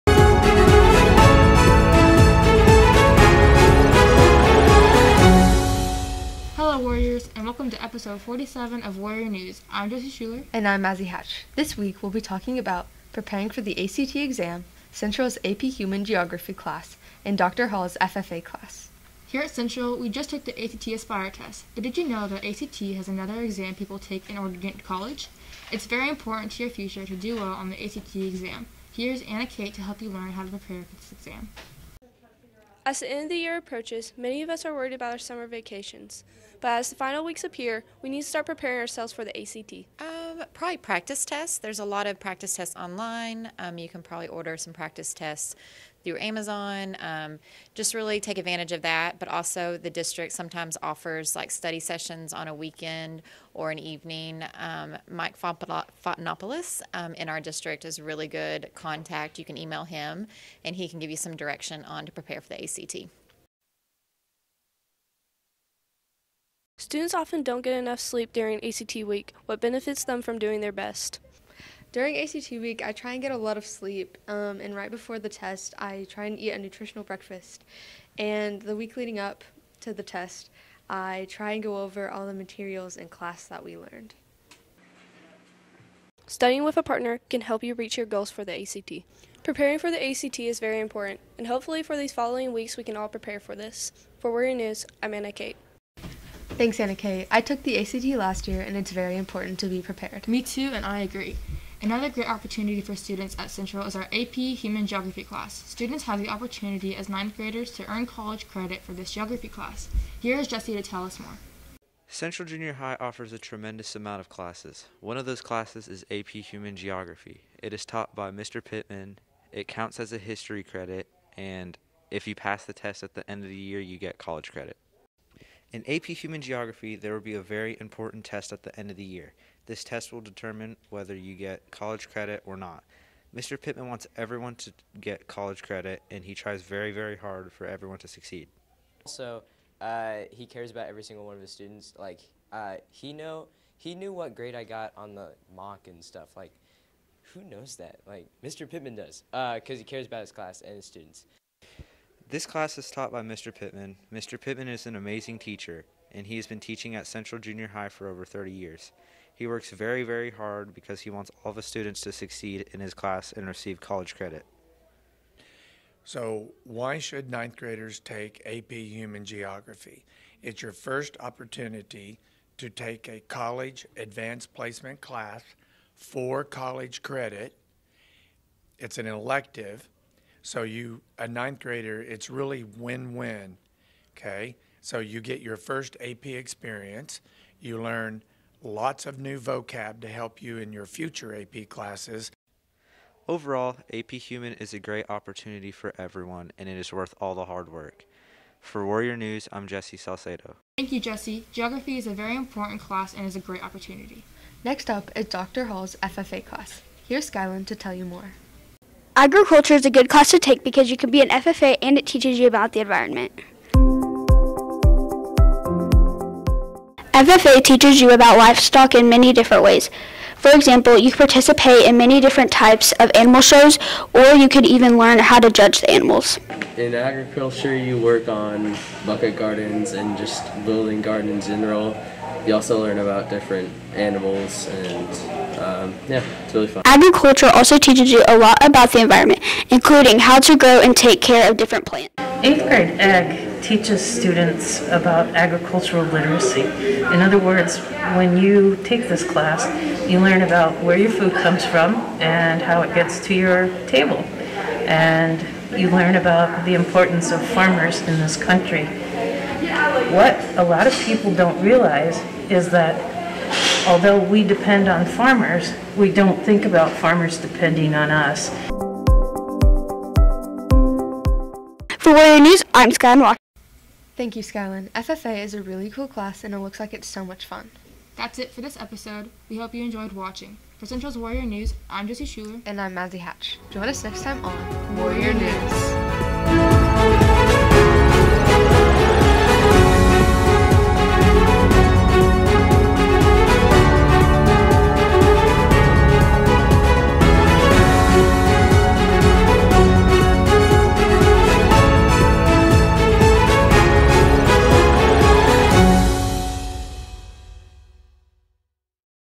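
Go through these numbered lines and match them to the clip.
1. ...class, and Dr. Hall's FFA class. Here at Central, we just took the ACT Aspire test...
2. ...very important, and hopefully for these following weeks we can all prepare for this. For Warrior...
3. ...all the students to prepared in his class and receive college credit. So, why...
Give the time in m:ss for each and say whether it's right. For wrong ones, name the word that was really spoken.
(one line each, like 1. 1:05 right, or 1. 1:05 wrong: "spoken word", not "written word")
1. 0:16 right
2. 1:30 right
3. 2:41 wrong: "succeed", not "prepared".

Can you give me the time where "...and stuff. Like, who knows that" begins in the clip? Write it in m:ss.
2:25.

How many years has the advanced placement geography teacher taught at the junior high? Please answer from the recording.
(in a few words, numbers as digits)
over 30.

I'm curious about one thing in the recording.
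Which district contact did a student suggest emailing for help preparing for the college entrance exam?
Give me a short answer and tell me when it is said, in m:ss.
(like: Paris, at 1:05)
Mike Fontanopoulos, at 0:55.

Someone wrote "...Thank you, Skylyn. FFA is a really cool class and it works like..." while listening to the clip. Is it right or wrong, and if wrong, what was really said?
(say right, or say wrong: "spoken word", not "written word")
wrong: "looks", not "works".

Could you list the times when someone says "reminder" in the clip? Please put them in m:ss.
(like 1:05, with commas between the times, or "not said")
not said.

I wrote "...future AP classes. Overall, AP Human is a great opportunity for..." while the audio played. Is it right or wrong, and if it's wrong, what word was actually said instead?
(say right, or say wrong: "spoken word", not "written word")
right.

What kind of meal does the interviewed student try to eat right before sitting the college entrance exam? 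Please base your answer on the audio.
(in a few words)
nutritional breakfast.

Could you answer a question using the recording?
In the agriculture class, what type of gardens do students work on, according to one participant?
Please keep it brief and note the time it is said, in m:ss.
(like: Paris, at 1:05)
bucket gardens, at 3:49.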